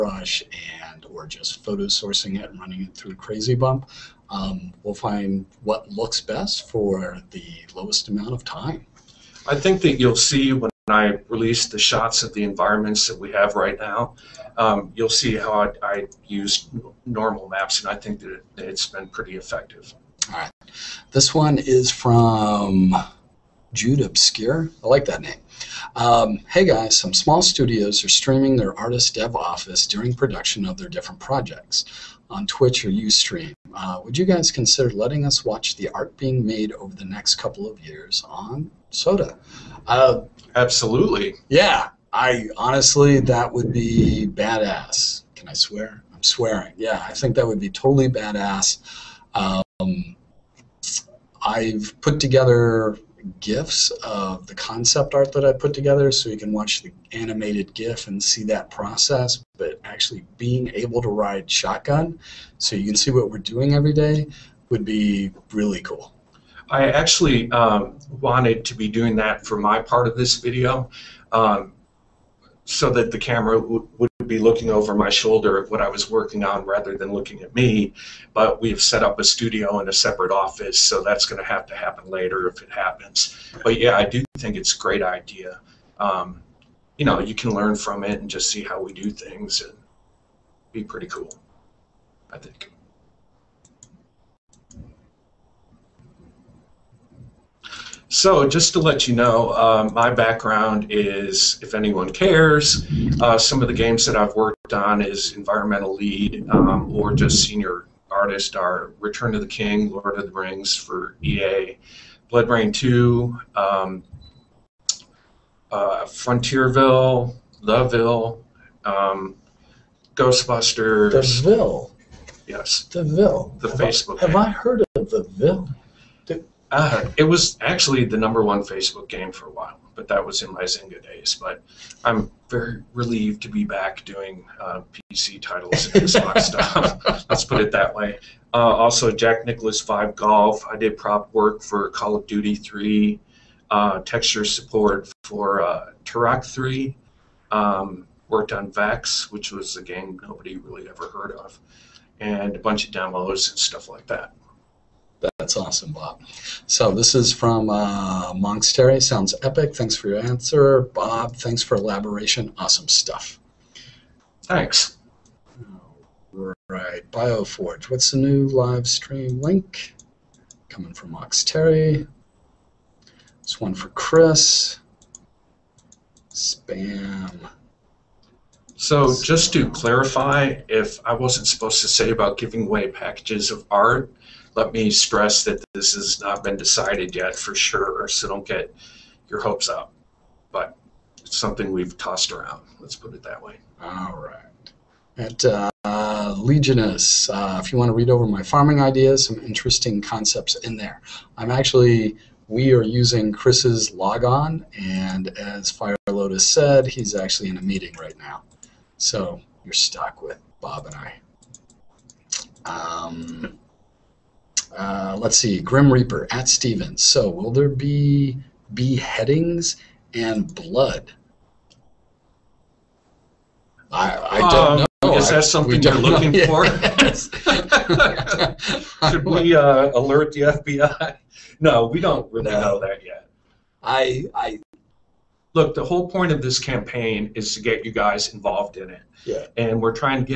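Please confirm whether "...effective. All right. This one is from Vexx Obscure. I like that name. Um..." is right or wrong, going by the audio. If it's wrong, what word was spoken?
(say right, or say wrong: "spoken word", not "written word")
wrong: "Jude", not "Vexx".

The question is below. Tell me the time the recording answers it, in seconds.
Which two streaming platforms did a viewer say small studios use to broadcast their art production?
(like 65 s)
32 s.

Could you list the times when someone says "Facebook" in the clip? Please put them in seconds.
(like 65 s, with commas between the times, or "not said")
123 s, 128 s.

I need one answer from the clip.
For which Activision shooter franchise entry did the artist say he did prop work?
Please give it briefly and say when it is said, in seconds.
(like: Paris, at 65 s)
Call of Duty 3, at 141 s.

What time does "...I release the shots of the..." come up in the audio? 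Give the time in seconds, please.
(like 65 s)
10 s.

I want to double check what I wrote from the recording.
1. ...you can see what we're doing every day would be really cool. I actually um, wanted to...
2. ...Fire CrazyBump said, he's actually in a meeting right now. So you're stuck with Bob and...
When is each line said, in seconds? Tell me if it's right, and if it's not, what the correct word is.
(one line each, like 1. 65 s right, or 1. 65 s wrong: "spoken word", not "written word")
1. 62 s right
2. 205 s wrong: "Lotus", not "CrazyBump".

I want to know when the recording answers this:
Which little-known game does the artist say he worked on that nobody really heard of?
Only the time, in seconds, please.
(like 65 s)
148 s.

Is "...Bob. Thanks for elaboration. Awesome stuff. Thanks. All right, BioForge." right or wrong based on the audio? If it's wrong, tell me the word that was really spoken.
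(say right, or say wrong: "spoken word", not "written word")
right.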